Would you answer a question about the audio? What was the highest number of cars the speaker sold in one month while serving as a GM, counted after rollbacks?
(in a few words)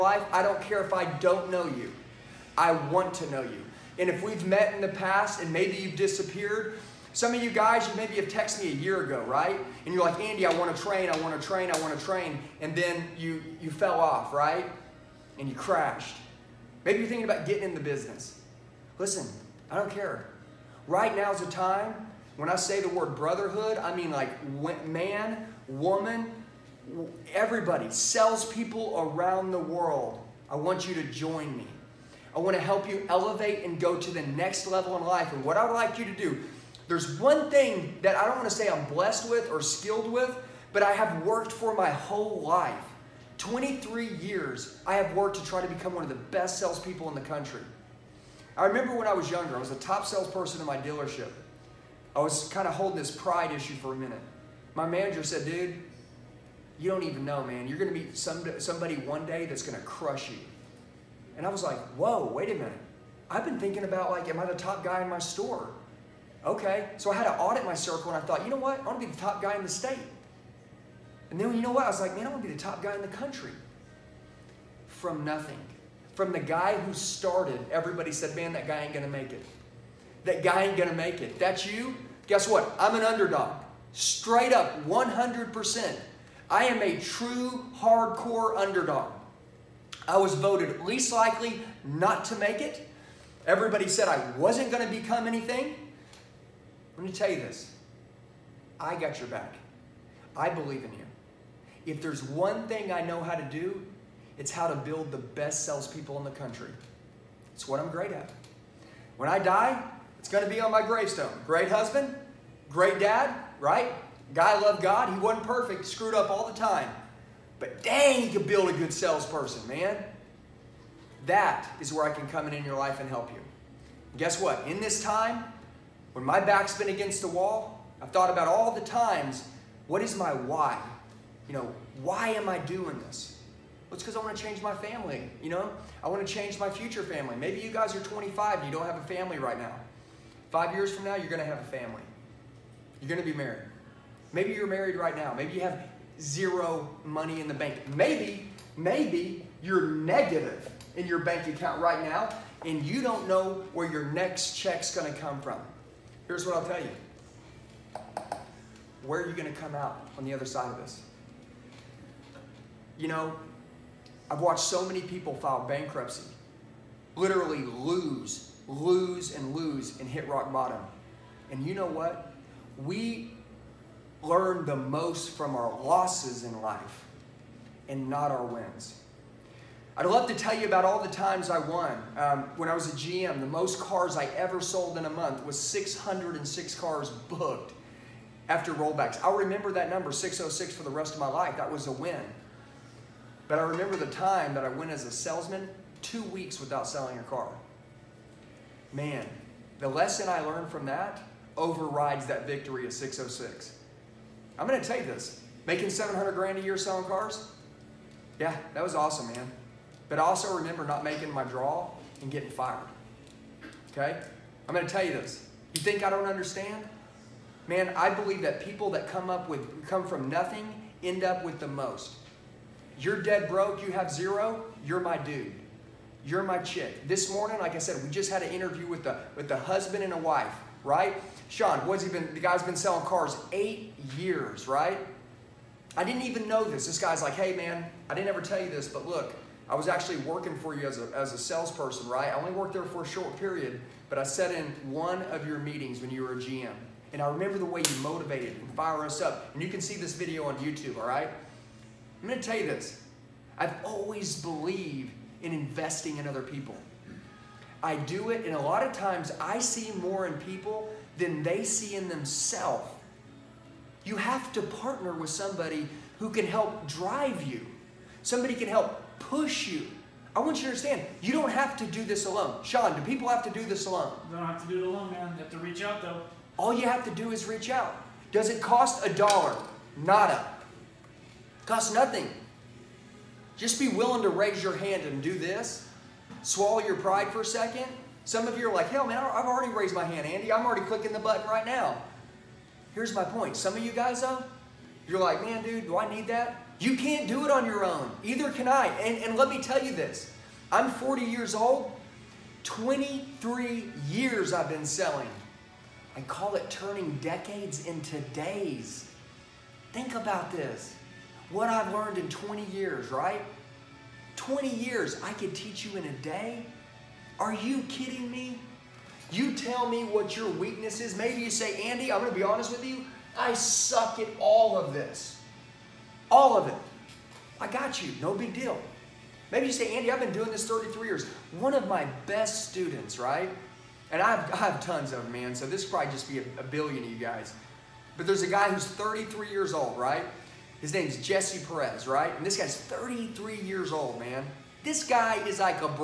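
606.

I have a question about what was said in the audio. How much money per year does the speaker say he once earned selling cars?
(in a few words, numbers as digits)
700 grand.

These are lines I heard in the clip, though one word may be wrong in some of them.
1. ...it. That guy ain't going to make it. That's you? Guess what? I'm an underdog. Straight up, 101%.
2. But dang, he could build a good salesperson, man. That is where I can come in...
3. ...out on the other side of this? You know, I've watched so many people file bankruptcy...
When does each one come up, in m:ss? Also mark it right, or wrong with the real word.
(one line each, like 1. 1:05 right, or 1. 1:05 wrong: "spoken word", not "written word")
1. 1:19 wrong: "100", not "101"
2. 1:57 right
3. 2:39 right.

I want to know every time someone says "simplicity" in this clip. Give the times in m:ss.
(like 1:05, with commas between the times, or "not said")
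not said.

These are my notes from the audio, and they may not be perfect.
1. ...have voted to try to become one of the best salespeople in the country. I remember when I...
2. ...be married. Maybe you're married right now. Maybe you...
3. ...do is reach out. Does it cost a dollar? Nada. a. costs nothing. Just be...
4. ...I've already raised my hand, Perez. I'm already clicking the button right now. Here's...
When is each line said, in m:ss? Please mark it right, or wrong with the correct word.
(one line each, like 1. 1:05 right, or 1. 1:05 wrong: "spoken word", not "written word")
1. 0:44 wrong: "worked", not "voted"
2. 2:23 right
3. 4:37 right
4. 4:49 wrong: "Andy", not "Perez".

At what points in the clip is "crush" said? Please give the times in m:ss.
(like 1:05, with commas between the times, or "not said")
0:59.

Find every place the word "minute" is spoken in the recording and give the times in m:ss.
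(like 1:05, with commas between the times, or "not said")
0:53, 1:02.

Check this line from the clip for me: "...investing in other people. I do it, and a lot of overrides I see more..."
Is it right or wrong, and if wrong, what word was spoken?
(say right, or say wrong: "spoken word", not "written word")
wrong: "times", not "overrides".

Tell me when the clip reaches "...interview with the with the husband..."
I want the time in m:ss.
3:48.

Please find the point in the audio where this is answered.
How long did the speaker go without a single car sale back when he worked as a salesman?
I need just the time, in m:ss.
3:16.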